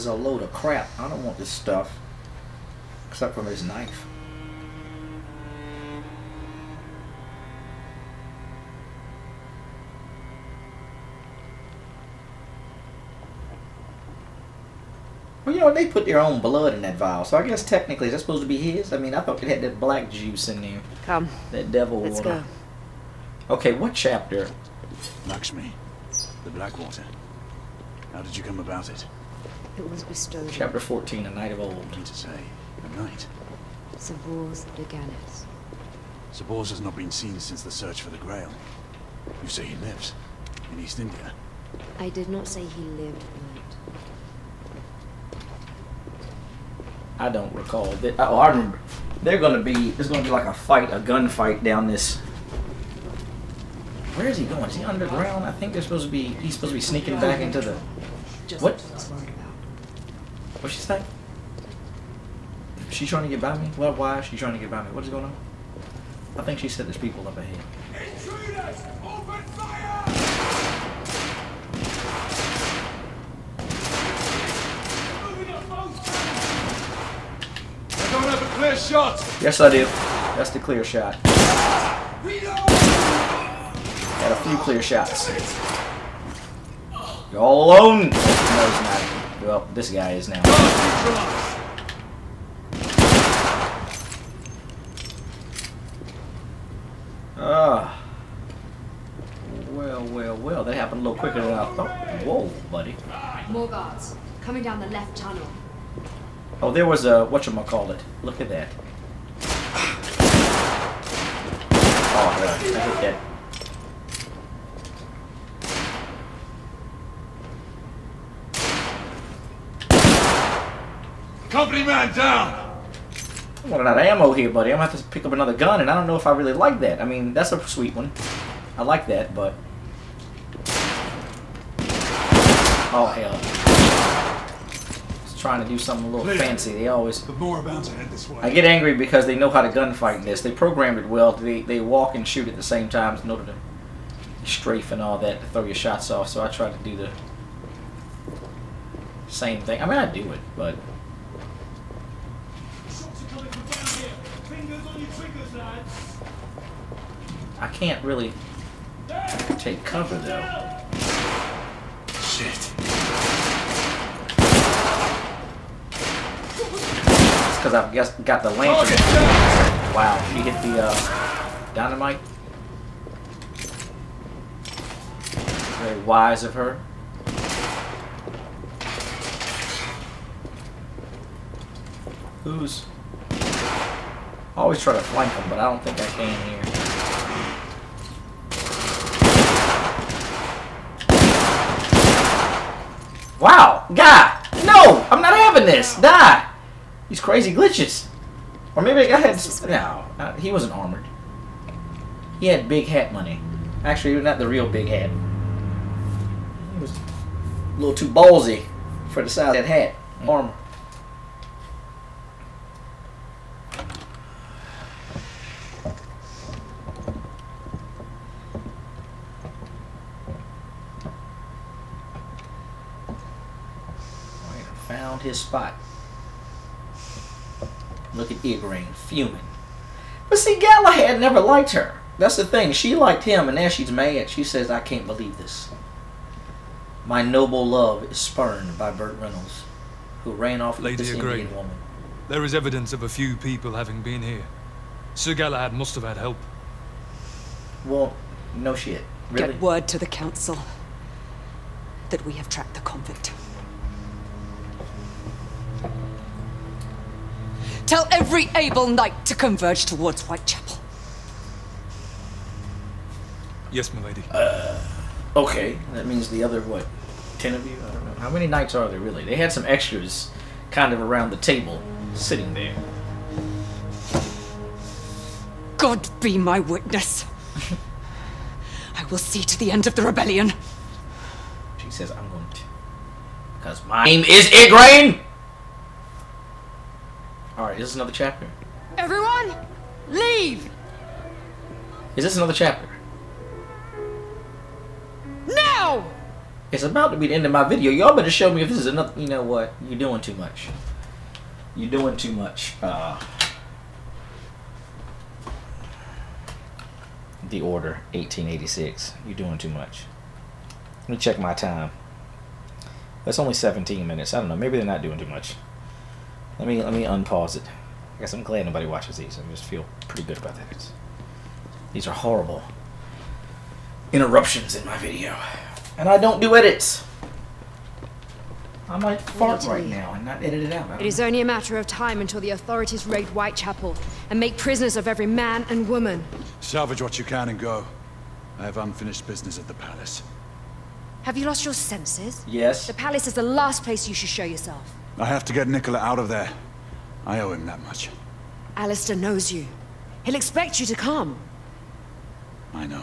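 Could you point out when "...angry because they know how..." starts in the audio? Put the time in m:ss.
2:18.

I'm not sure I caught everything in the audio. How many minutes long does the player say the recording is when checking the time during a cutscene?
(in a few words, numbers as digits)
17.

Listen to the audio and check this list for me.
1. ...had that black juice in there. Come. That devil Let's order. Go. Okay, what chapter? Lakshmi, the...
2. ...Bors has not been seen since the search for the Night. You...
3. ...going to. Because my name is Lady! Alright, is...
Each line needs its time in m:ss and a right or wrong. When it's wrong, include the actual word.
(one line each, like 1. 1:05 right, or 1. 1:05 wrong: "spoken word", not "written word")
1. 0:19 wrong: "water", not "order"
2. 0:36 wrong: "Grail", not "Night"
3. 4:42 wrong: "Igraine", not "Lady".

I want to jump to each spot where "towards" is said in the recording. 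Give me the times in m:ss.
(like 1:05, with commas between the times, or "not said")
4:19.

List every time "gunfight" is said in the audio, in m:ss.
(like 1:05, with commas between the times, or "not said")
0:50, 2:19.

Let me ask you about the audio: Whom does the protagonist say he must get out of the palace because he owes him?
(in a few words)
Nikola.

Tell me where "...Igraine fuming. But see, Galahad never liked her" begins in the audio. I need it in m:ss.
3:48.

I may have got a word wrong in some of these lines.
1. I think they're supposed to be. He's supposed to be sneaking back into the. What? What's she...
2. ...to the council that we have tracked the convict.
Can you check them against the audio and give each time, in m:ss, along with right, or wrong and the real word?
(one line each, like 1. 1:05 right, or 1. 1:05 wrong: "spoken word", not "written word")
1. 0:55 right
2. 4:09 right.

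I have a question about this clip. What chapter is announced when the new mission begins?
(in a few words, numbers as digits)
Chapter 14.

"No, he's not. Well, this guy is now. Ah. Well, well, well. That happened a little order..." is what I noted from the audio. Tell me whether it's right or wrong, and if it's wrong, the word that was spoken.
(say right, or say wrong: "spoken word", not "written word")
wrong: "quicker", not "order".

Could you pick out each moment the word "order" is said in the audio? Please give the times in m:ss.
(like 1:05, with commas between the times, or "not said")
2:23, 5:07.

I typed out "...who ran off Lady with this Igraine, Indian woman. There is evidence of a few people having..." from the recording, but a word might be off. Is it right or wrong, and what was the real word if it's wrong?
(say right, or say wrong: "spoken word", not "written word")
right.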